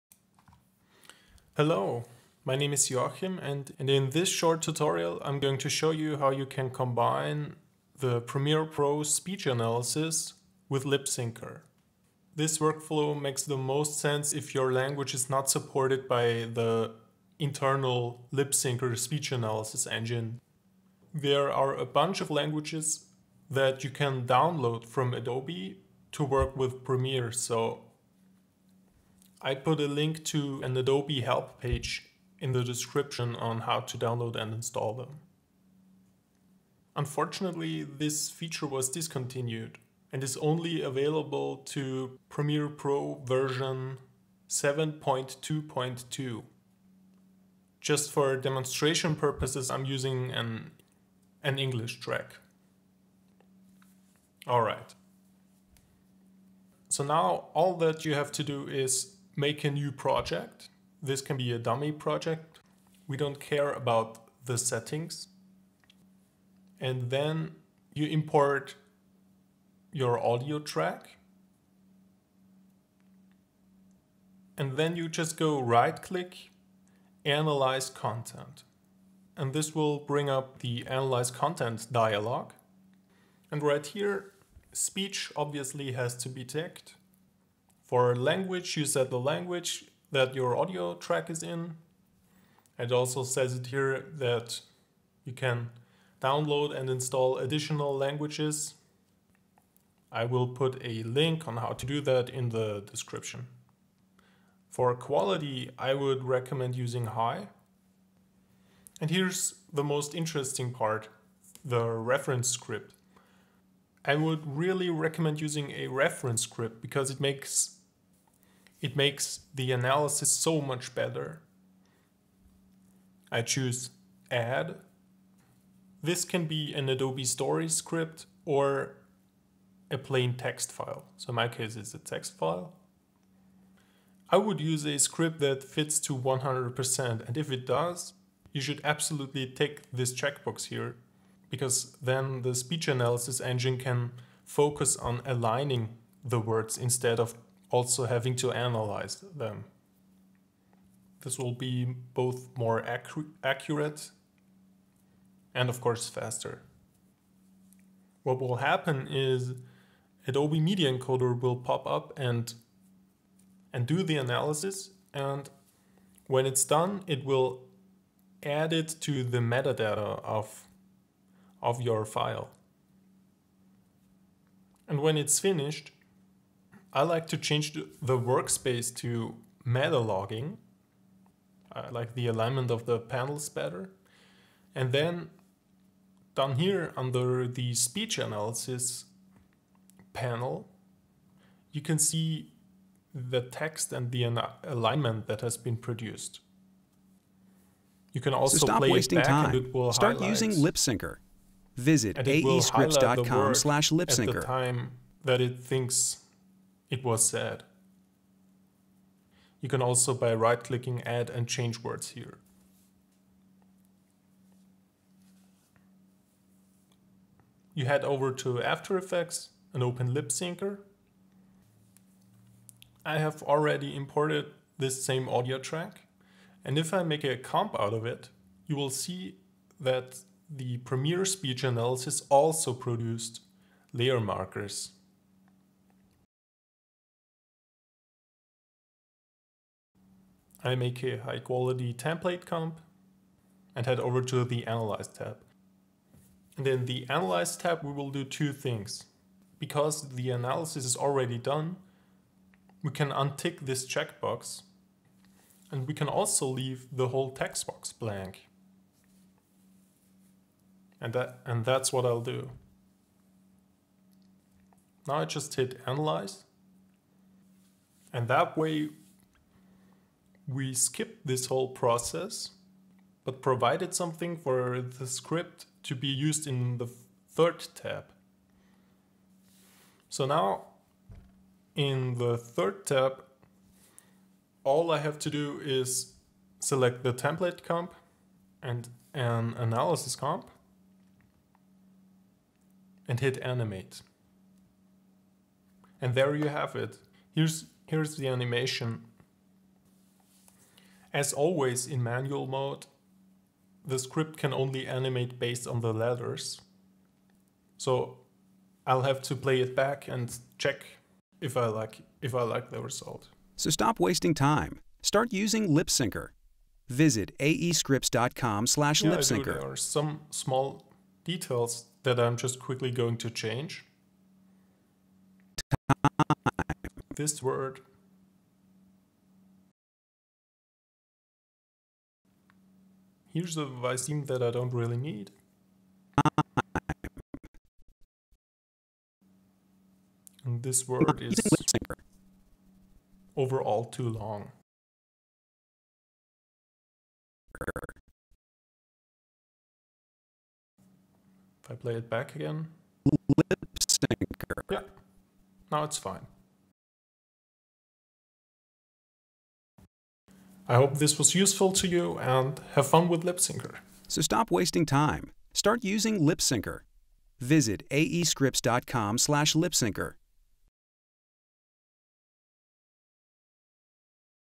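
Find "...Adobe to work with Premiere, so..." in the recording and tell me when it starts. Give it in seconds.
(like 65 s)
25 s.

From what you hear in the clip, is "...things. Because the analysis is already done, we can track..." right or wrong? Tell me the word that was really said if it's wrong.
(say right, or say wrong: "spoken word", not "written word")
wrong: "untick", not "track".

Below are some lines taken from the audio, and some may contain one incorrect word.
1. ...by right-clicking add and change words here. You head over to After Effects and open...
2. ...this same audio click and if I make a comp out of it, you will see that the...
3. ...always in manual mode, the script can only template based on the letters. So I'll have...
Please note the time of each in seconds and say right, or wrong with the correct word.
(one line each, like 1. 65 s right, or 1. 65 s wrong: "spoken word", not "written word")
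1. 210 s right
2. 224 s wrong: "track", not "click"
3. 301 s wrong: "animate", not "template".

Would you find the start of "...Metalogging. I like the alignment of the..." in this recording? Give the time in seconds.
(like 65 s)
179 s.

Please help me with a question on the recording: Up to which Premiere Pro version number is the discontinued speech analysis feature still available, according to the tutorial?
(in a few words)
7.2.2.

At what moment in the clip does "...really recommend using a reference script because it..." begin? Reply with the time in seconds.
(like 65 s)
114 s.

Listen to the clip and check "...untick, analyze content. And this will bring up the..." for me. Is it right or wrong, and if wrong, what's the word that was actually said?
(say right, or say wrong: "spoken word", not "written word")
wrong: "click", not "untick".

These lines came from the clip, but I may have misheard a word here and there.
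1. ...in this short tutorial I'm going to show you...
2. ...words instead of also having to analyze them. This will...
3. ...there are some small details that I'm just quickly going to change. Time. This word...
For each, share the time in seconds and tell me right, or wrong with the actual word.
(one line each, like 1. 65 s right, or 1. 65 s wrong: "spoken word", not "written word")
1. 3 s right
2. 146 s right
3. 319 s right.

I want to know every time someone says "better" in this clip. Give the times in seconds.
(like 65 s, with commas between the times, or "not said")
120 s, 183 s.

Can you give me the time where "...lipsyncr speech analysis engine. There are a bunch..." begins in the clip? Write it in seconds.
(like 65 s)
18 s.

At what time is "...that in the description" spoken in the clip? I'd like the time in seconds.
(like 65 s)
101 s.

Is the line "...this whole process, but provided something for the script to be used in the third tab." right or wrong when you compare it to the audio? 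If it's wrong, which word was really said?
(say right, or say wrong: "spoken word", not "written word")
right.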